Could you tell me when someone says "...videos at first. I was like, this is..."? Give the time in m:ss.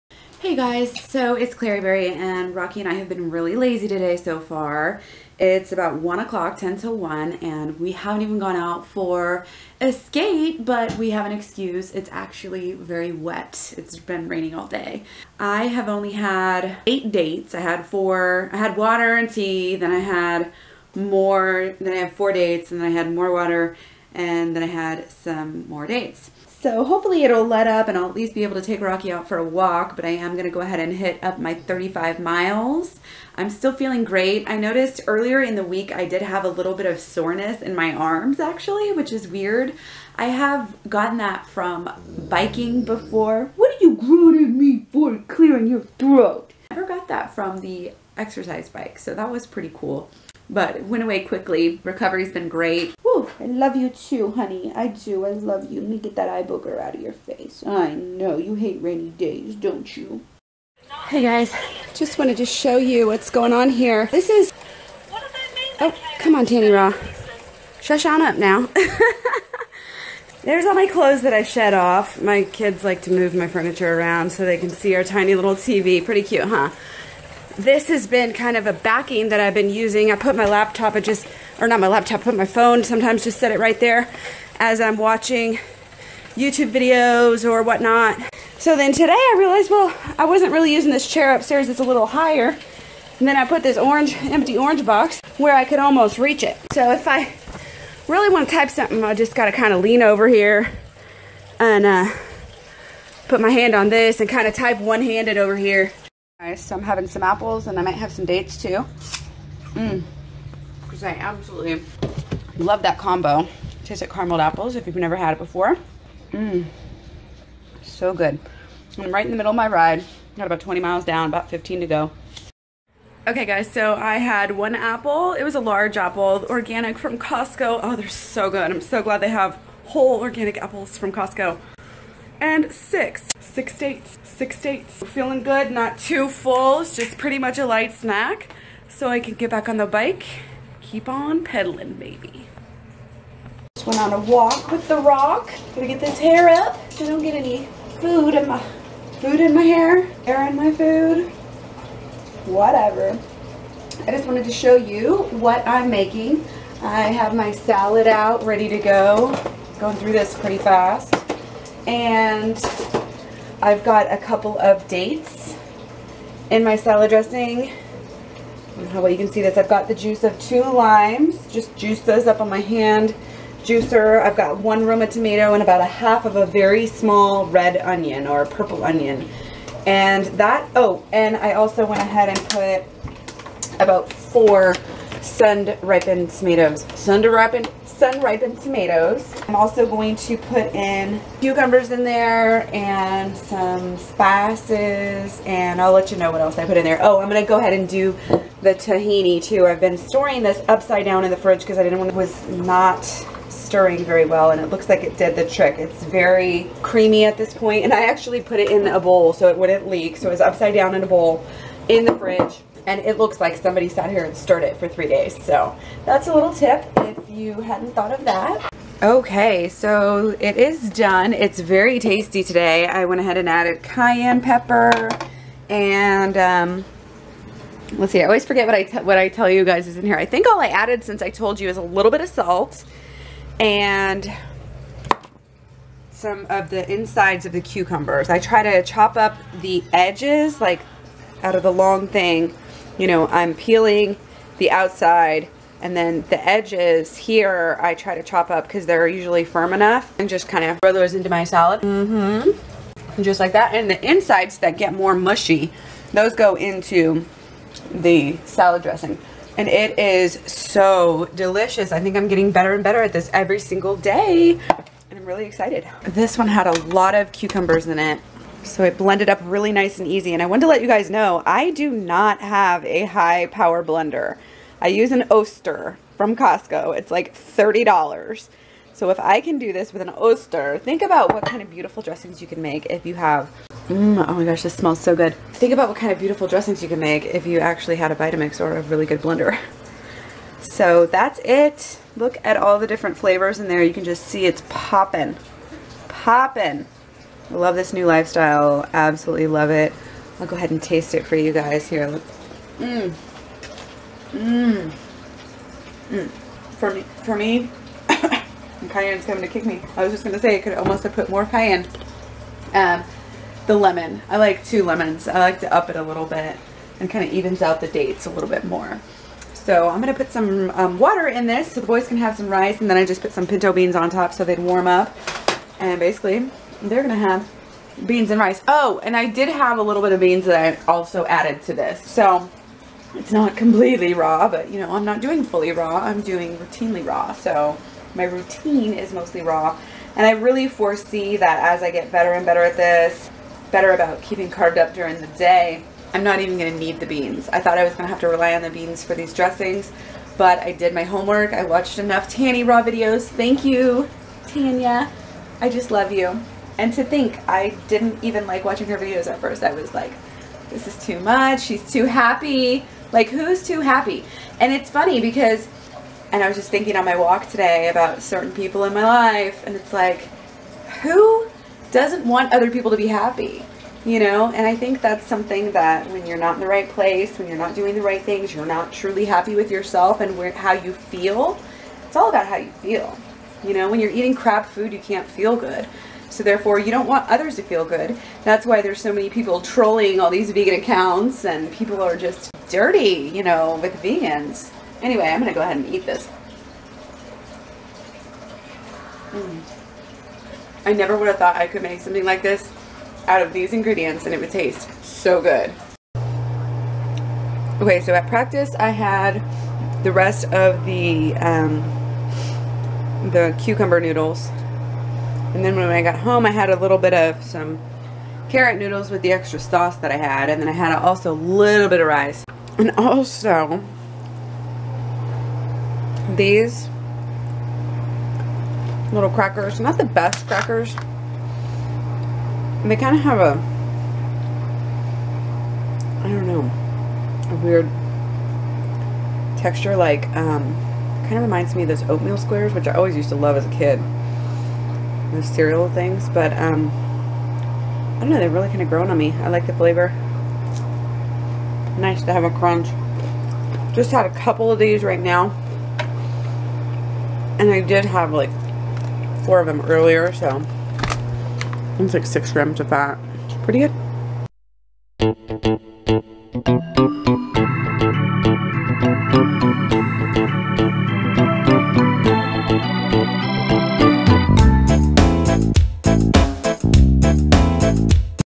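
5:58.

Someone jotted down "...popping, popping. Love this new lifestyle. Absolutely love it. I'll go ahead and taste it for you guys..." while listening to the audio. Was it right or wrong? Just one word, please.
right.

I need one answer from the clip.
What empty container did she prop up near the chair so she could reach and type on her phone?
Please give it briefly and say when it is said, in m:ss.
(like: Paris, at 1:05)
orange box, at 1:34.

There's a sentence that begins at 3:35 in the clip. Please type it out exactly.
So that's a little tip if you hadn't thought of that.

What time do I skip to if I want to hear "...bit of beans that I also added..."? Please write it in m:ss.
5:30.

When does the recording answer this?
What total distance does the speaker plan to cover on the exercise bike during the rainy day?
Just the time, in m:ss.
0:31.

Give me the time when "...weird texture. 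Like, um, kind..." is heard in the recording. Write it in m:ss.
7:17.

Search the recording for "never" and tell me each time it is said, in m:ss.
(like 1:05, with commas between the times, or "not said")
0:46, 1:54, 6:40.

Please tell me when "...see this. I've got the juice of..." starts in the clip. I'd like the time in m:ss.
2:49.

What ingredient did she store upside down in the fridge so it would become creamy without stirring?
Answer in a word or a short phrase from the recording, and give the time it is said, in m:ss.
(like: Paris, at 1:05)
tahini, at 3:18.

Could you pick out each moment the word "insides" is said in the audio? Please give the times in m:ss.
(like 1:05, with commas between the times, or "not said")
3:56, 4:14.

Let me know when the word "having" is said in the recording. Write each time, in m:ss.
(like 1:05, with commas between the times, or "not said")
1:46.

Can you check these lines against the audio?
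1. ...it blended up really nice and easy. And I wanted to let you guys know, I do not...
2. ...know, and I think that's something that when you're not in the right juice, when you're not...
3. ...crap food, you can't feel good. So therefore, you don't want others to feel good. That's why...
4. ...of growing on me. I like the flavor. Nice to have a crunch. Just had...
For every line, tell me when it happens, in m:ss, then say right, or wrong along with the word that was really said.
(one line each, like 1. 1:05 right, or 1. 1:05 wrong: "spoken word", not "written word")
1. 4:28 right
2. 6:14 wrong: "place", not "juice"
3. 6:24 right
4. 7:28 right.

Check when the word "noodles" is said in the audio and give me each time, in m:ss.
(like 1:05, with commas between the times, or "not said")
6:53, 6:58.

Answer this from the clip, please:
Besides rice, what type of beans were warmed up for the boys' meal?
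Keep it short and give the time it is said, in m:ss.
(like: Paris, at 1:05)
pinto beans, at 5:23.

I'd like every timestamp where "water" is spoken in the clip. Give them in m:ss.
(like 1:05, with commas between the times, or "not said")
0:18, 0:23, 5:20.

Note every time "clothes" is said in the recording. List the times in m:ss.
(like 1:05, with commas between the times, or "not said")
1:10.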